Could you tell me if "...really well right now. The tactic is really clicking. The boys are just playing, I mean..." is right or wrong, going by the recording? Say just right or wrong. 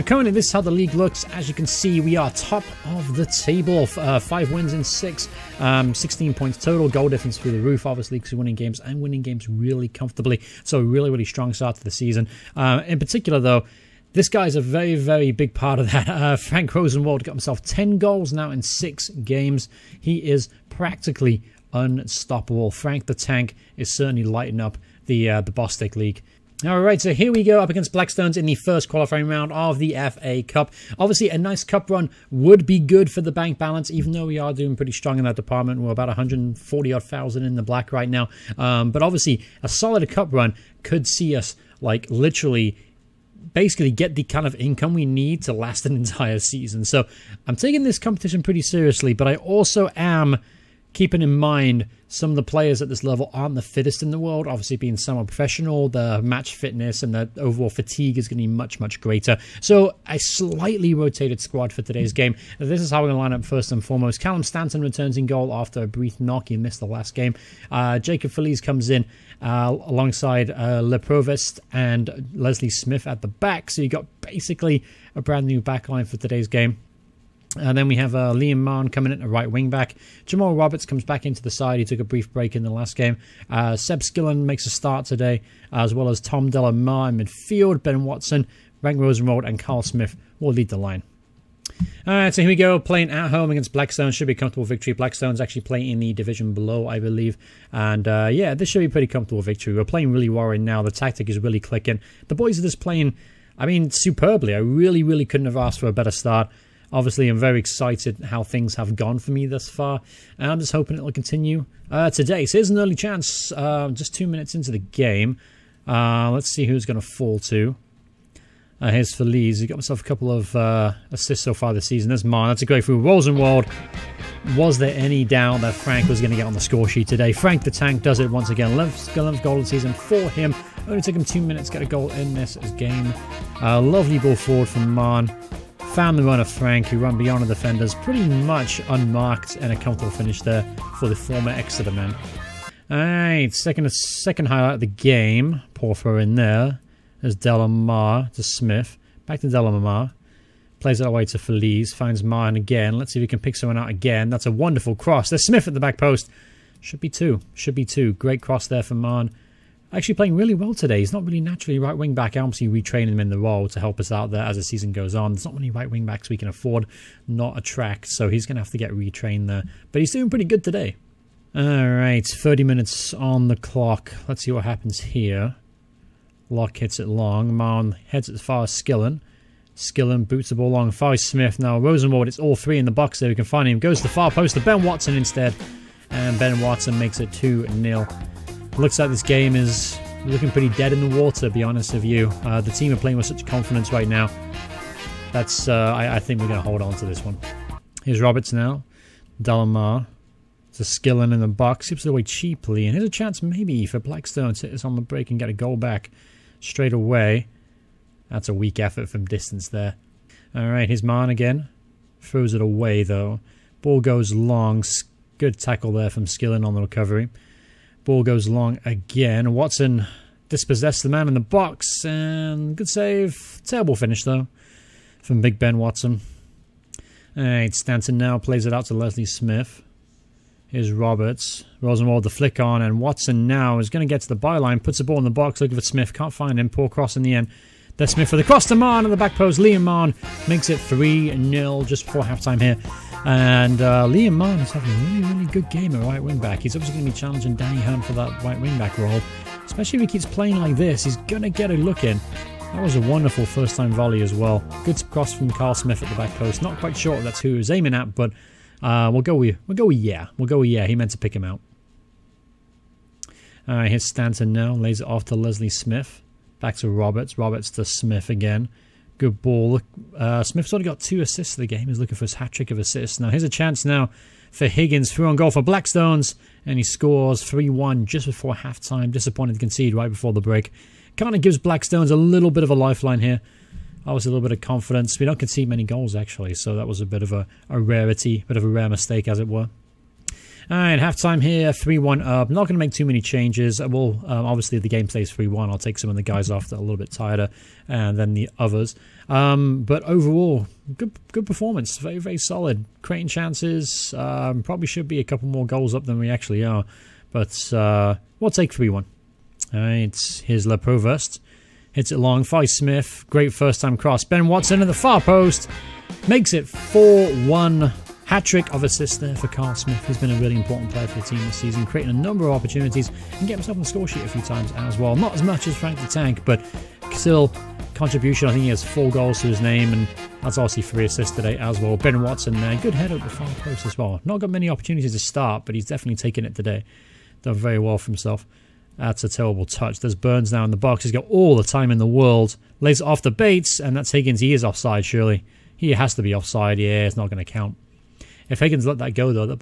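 right.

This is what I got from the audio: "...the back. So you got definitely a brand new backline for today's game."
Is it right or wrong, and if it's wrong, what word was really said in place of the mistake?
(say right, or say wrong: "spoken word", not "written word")
wrong: "basically", not "definitely".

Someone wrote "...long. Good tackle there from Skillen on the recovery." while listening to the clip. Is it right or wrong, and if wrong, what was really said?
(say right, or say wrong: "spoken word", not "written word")
right.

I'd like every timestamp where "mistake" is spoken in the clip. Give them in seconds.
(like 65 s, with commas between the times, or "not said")
288 s.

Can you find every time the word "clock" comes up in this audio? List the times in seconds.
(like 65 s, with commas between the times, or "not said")
173 s.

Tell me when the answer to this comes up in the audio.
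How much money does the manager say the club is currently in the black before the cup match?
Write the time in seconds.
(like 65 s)
36 s.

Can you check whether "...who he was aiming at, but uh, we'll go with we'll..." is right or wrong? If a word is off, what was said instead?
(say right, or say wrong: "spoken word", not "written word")
right.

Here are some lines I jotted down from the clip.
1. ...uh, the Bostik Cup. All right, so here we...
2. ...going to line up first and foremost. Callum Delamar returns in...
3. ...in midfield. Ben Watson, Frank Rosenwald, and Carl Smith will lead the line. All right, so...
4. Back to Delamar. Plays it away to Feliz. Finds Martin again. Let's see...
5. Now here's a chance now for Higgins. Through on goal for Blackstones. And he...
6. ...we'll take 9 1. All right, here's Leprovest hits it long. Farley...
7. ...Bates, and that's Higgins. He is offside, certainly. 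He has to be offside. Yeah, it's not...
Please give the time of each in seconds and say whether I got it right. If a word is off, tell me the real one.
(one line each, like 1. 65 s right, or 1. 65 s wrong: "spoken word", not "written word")
1. 25 s wrong: "League", not "Cup"
2. 63 s wrong: "Stanton", not "Delamar"
3. 87 s right
4. 149 s right
5. 273 s right
6. 308 s wrong: "3", not "9"
7. 343 s wrong: "surely", not "certainly".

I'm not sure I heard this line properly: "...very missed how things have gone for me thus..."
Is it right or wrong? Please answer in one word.
wrong.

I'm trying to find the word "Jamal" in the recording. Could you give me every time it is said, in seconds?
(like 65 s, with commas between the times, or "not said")
80 s.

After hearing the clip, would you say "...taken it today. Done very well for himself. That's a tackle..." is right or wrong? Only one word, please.
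wrong.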